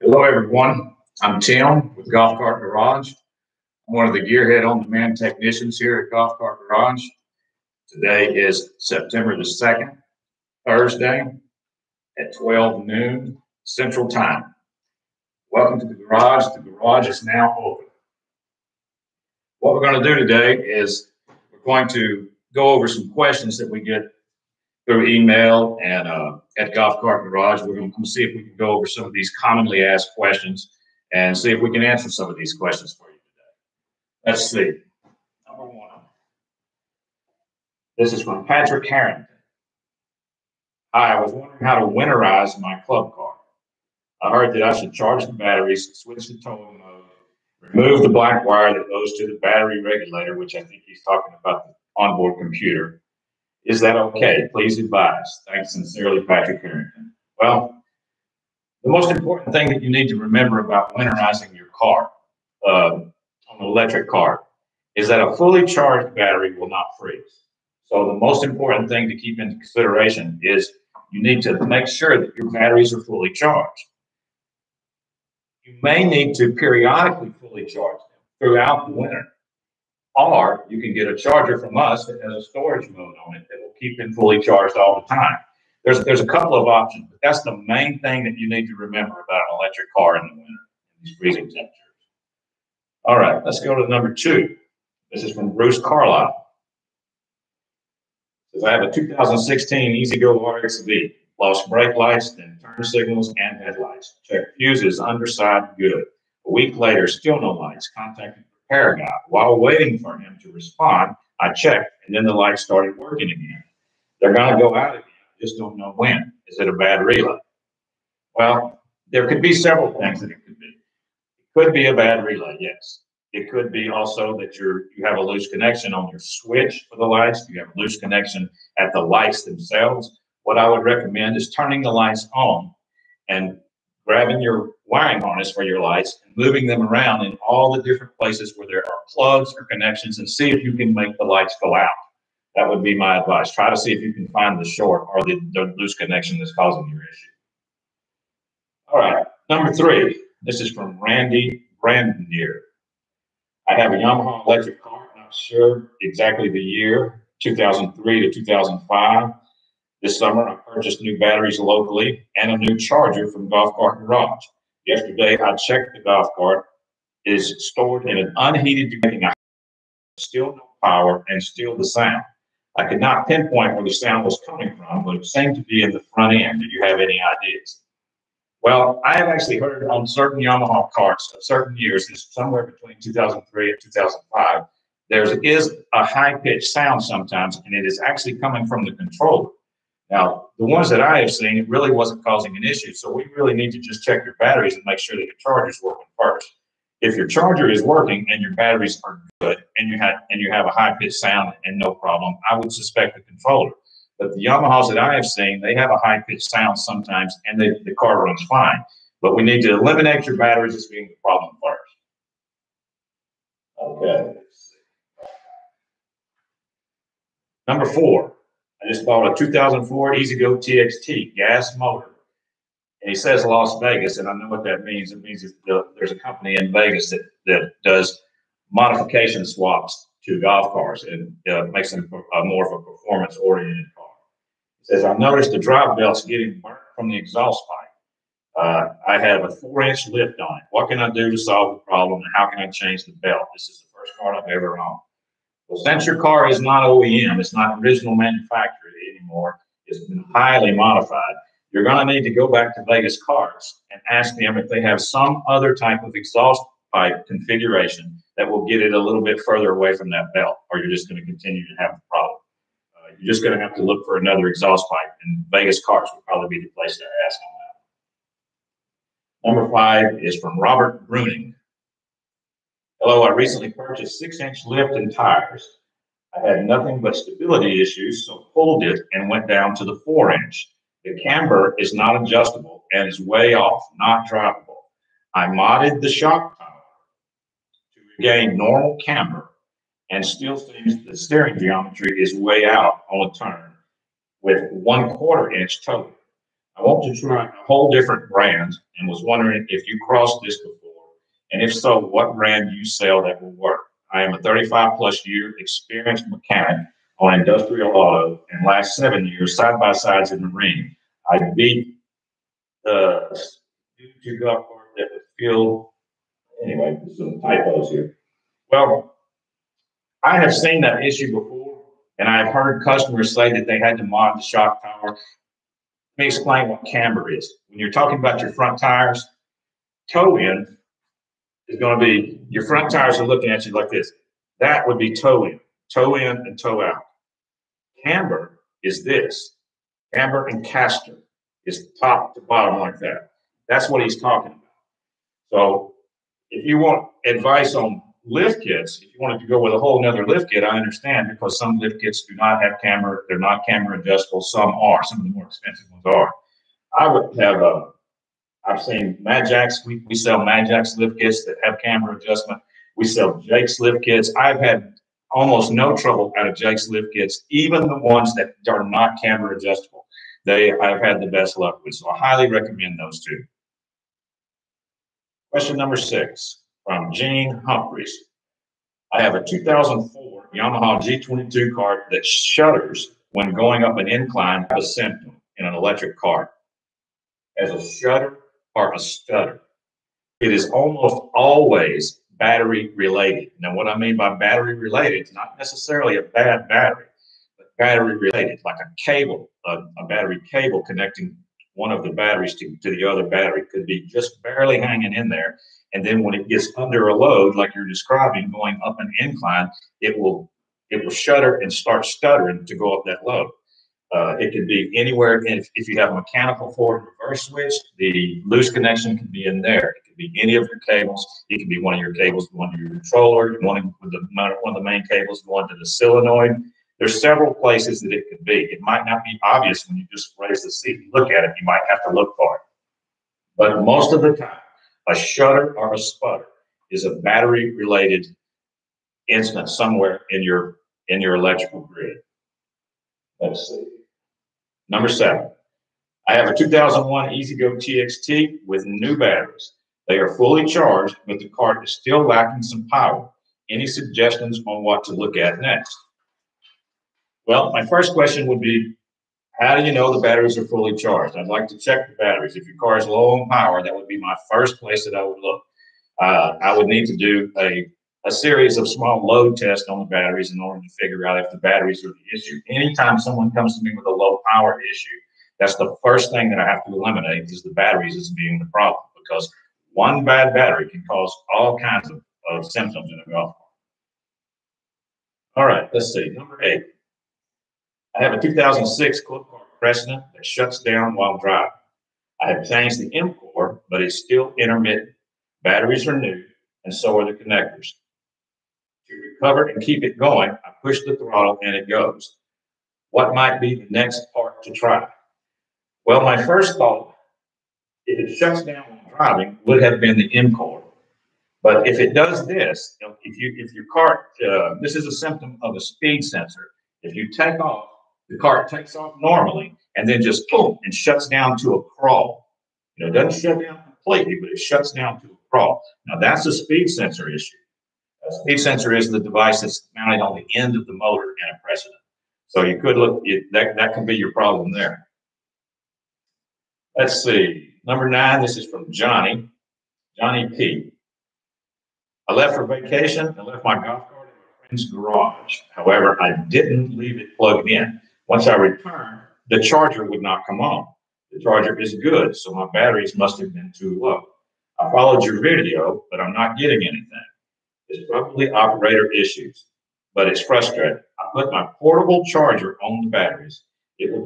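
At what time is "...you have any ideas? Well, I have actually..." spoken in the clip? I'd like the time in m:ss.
2:56.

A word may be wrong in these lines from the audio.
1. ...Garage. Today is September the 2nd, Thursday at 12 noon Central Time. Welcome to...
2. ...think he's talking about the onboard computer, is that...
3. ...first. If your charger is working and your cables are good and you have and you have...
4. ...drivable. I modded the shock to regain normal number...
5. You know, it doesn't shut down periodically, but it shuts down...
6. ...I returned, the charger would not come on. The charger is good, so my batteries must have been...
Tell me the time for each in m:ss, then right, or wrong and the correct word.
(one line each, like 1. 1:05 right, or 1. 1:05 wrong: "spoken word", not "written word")
1. 0:06 right
2. 0:50 right
3. 3:16 wrong: "batteries", not "cables"
4. 4:44 wrong: "camber", not "number"
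5. 8:42 wrong: "completely", not "periodically"
6. 9:08 right.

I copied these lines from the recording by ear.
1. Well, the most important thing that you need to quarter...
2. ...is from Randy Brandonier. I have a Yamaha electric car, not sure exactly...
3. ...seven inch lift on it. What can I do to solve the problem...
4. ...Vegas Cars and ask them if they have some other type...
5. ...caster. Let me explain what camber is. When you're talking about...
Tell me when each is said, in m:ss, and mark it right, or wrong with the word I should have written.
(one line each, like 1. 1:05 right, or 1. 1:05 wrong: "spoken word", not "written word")
1. 0:57 wrong: "remember", not "quarter"
2. 2:30 right
3. 3:59 wrong: "four", not "seven"
4. 4:12 right
5. 5:24 wrong: "tower", not "caster".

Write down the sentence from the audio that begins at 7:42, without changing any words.
If your car is low on power, that would be my first place that I would look.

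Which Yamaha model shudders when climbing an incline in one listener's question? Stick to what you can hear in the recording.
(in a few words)
G22.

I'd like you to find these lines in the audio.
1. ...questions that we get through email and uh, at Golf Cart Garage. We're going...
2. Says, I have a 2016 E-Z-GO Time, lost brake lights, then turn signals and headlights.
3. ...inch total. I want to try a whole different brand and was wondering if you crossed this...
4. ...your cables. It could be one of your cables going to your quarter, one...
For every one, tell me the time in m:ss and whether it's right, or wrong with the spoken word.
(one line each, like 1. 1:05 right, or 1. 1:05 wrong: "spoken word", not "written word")
1. 0:23 right
2. 1:38 wrong: "RXV", not "Time"
3. 4:55 right
4. 7:00 wrong: "controller", not "quarter".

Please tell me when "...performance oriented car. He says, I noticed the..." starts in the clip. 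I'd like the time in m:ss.
3:52.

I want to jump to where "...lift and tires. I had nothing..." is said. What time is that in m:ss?
4:34.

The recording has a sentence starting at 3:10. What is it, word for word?
Now, the ones that I have seen, it really wasn't causing an issue.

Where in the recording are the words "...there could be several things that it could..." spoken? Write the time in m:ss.
1:59.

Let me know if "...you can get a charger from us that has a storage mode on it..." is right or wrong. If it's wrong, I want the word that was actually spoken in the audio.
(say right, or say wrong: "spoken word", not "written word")
right.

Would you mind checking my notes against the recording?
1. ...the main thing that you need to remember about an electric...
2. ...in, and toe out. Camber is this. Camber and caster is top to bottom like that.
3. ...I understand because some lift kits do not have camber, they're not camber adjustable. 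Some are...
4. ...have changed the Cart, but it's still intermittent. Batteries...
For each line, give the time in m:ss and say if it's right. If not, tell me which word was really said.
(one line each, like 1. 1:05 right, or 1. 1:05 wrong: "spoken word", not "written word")
1. 1:27 right
2. 5:36 right
3. 5:50 right
4. 8:12 wrong: "MCOR", not "Cart".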